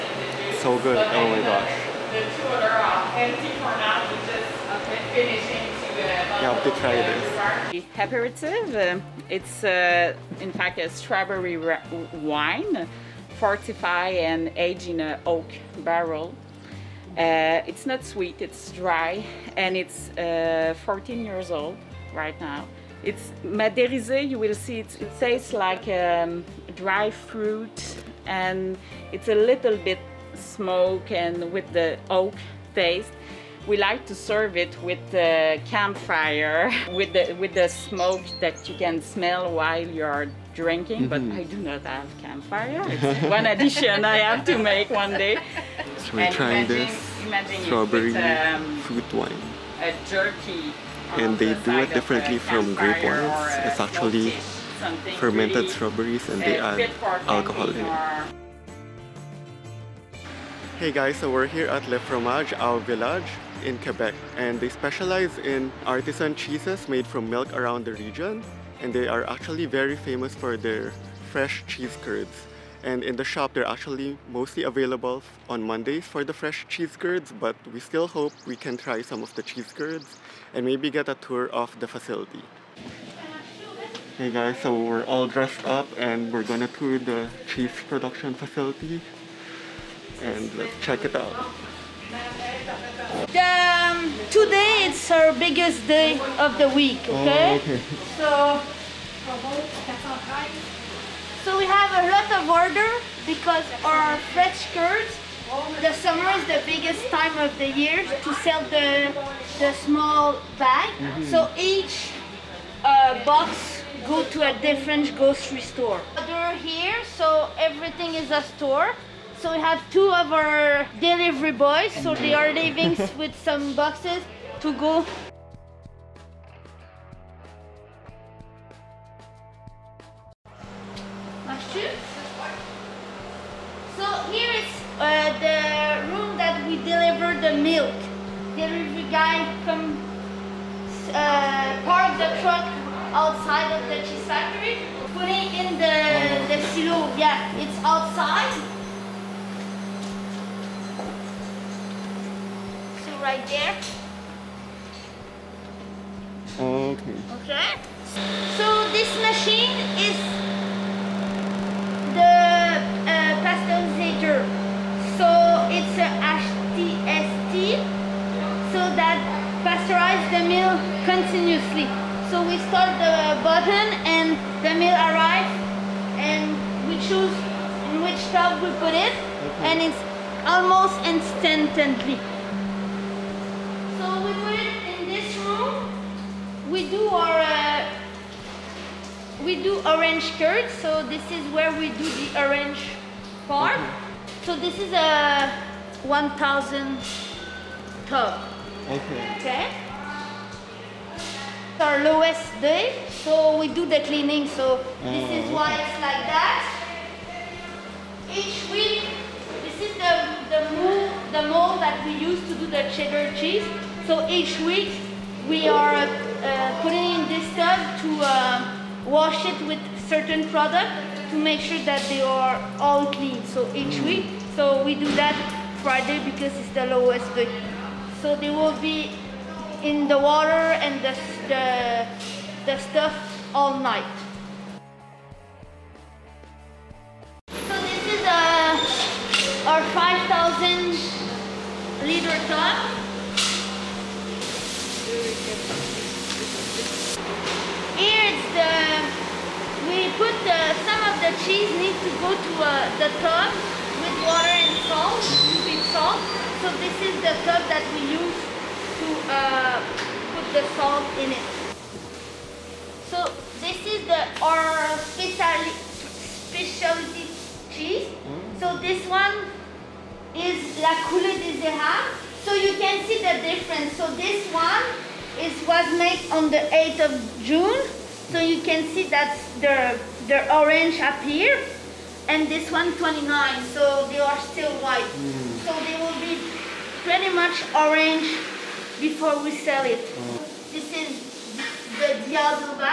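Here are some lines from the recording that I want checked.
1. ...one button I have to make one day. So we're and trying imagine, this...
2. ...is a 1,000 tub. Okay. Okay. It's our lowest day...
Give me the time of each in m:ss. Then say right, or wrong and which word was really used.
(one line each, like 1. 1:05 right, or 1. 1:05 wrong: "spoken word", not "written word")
1. 0:43 wrong: "addition", not "button"
2. 3:14 right.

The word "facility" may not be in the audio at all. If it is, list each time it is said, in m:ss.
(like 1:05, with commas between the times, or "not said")
1:21, 1:28.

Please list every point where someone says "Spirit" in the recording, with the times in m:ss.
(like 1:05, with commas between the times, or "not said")
not said.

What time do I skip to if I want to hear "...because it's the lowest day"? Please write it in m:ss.
3:46.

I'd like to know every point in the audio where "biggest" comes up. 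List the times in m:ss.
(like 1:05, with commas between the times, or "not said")
1:35, 1:46.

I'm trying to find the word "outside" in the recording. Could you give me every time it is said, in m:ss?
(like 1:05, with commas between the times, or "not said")
2:23, 2:27.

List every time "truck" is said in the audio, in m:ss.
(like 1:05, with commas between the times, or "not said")
2:22.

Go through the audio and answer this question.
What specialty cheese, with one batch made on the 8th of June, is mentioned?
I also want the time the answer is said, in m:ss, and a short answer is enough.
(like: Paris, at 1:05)
La Coule des Érables, at 4:30.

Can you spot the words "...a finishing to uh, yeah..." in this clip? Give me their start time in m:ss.
0:04.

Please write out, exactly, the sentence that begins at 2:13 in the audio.
So here is uh, the room that we deliver the milk.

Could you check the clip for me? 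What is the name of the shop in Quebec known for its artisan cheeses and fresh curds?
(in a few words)
Le Fromage au Village.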